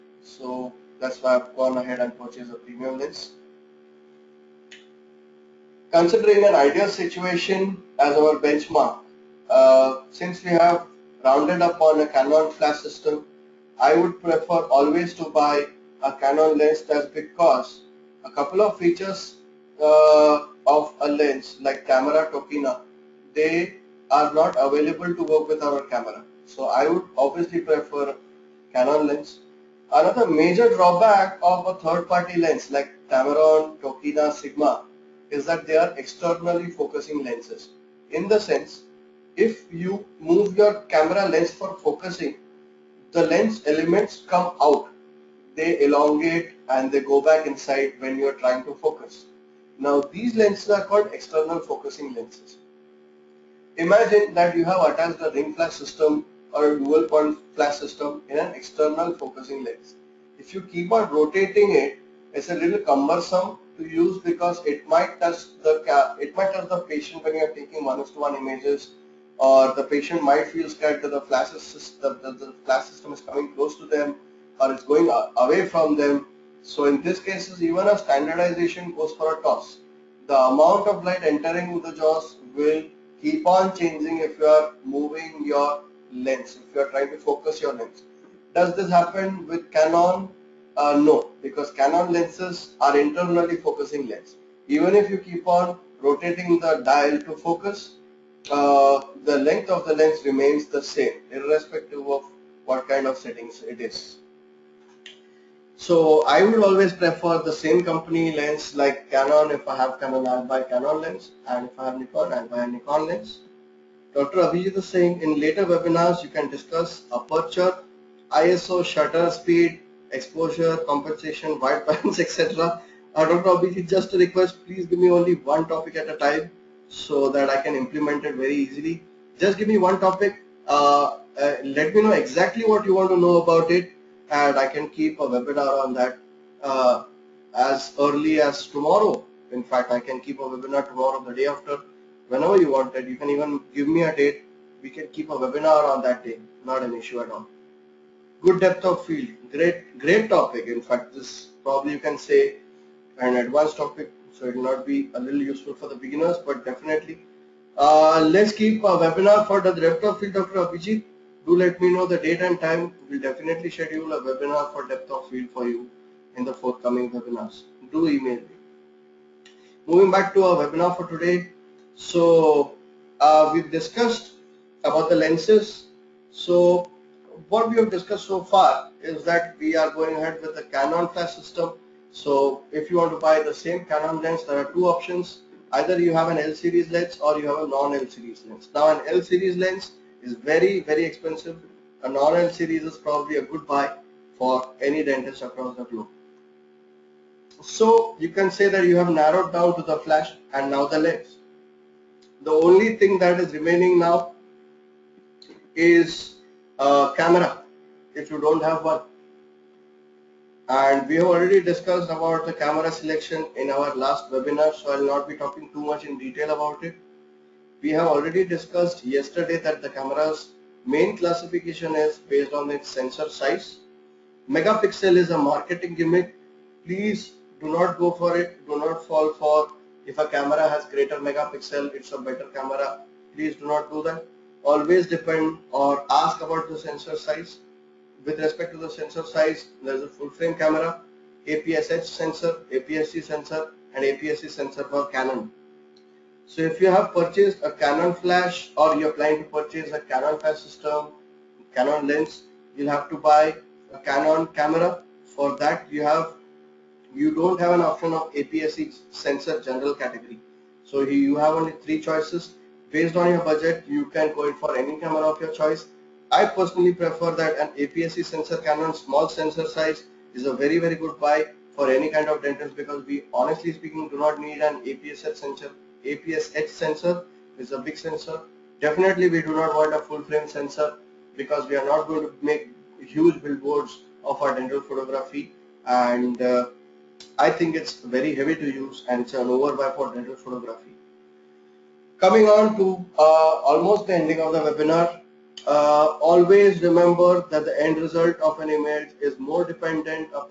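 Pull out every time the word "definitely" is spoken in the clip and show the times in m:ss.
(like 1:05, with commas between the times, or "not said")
2:36, 2:43, 4:38.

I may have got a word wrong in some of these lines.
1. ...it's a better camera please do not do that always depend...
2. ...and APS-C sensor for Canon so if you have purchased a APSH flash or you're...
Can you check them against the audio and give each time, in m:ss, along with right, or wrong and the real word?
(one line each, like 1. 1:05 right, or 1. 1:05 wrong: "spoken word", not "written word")
1. 3:51 right
2. 4:03 wrong: "Canon", not "APSH".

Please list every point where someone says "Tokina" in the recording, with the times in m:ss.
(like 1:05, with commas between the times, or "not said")
0:22, 0:33.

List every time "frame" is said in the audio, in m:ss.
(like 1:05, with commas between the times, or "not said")
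4:00, 4:40.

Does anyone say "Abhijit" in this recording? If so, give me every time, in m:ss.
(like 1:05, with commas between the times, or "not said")
1:54, 2:03, 2:40.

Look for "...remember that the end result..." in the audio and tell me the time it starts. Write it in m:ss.
4:56.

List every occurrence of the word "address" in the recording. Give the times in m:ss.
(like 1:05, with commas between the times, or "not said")
not said.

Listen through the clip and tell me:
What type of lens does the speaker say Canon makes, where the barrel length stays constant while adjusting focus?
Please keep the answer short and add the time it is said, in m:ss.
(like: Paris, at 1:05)
Internally focusing lens, at 1:32.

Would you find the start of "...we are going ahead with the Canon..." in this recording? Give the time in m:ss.
2:59.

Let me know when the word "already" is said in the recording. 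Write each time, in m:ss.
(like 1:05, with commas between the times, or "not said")
3:31, 3:38.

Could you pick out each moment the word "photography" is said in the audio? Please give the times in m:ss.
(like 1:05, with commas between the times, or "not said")
4:44, 4:50.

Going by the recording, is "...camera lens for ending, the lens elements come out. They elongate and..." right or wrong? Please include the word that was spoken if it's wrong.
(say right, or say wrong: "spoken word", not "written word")
wrong: "focusing", not "ending".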